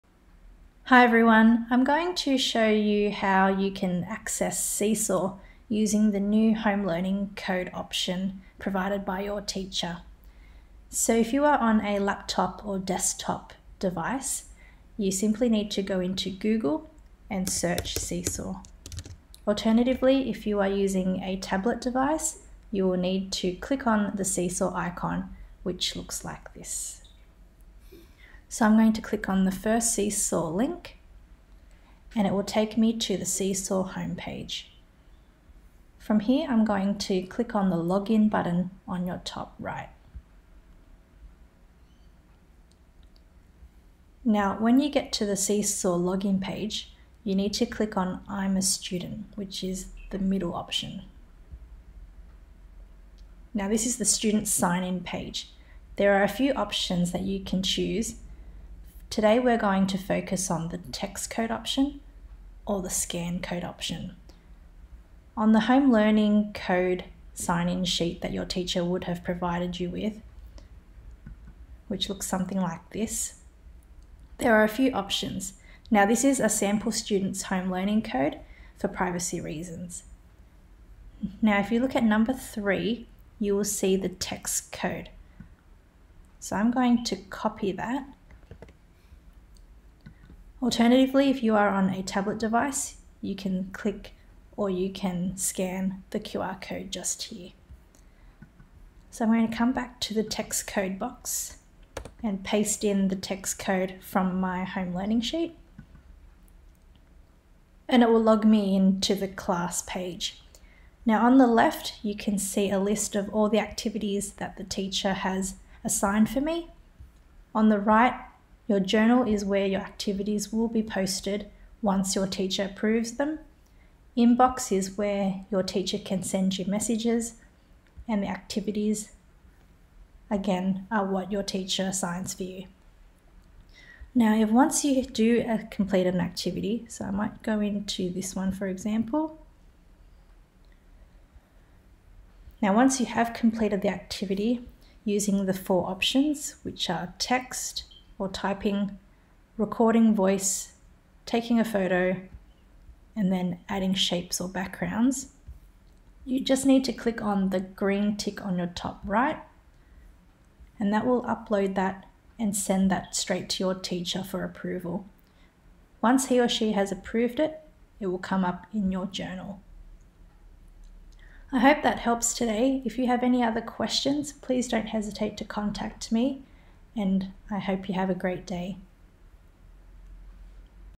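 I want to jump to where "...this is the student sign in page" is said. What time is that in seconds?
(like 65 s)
53 s.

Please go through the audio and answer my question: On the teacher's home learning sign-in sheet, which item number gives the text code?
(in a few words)
3.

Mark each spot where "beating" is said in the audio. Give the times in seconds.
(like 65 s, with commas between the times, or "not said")
not said.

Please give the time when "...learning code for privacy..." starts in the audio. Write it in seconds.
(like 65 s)
77 s.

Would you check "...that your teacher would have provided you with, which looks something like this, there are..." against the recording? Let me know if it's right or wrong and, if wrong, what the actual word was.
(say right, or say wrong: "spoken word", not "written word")
right.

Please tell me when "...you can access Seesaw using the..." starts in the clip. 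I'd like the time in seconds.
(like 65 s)
3 s.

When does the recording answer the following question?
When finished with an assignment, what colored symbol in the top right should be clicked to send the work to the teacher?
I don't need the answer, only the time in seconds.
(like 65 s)
157 s.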